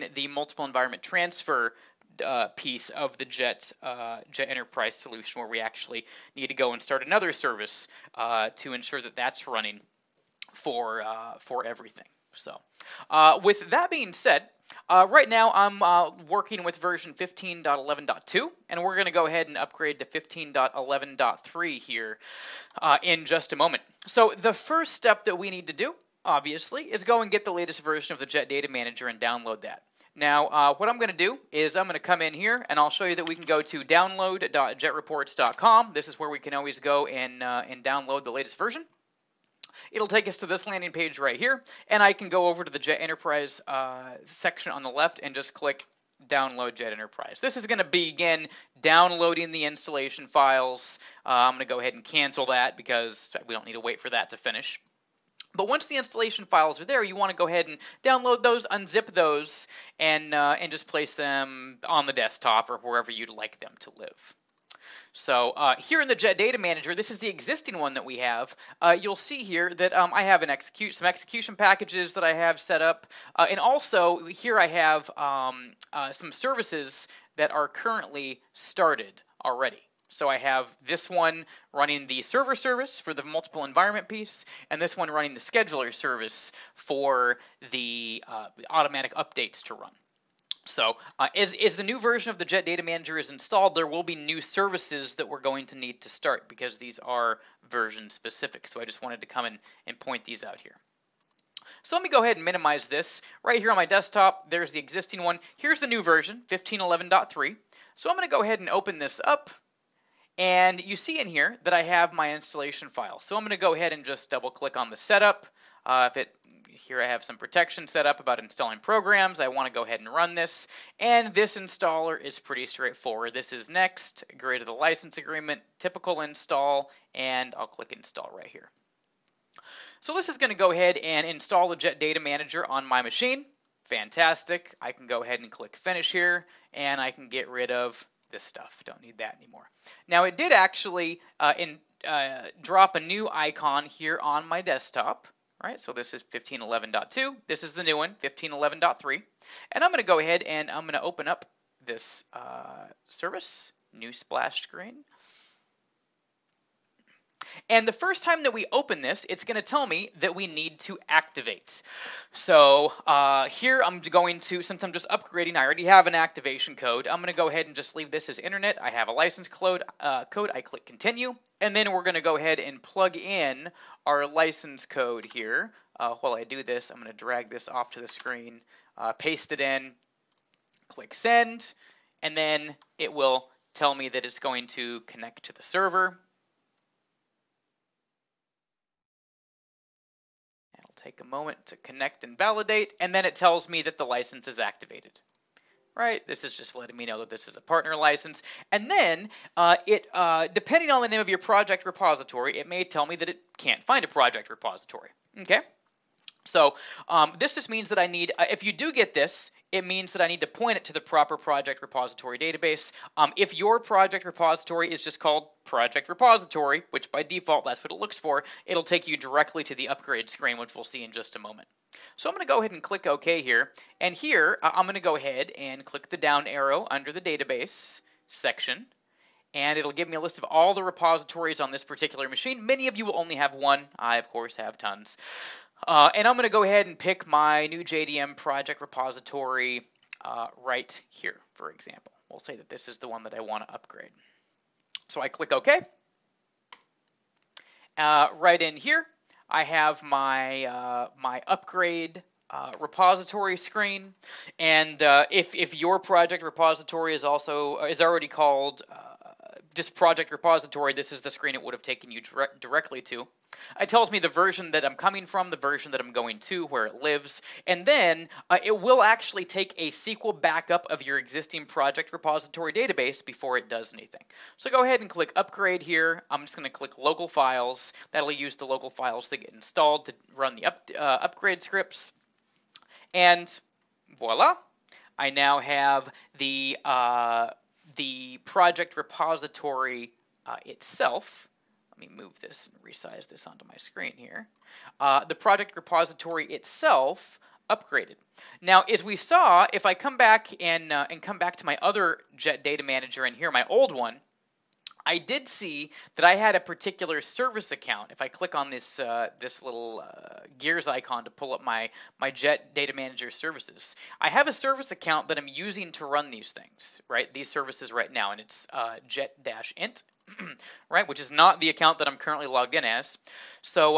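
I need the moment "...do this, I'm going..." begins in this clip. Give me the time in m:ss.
2:56.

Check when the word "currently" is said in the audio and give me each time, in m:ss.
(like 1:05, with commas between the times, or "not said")
1:17, 5:22.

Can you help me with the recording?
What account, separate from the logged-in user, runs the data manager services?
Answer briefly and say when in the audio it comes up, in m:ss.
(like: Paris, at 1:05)
Jet-int, at 5:19.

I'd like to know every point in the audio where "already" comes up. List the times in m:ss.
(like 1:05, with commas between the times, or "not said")
1:19, 2:45, 4:18.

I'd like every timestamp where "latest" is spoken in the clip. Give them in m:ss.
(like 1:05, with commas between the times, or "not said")
0:27, 0:38.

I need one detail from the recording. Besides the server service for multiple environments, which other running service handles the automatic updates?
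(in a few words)
scheduler service.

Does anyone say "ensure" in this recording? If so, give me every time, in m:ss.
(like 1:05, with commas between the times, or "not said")
0:08.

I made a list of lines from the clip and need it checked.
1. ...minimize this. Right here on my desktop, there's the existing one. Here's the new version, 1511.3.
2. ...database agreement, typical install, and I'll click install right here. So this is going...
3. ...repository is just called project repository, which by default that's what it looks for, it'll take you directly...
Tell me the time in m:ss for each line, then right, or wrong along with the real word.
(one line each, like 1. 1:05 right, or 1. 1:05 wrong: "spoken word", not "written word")
1. 1:42 right
2. 2:04 wrong: "license", not "database"
3. 3:34 right.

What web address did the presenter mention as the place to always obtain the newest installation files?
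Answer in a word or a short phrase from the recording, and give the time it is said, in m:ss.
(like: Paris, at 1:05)
download.jetreports.com, at 0:33.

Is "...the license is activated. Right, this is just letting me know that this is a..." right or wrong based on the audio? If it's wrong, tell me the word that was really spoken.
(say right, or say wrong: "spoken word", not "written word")
right.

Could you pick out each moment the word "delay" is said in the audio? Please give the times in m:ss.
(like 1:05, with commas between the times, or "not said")
not said.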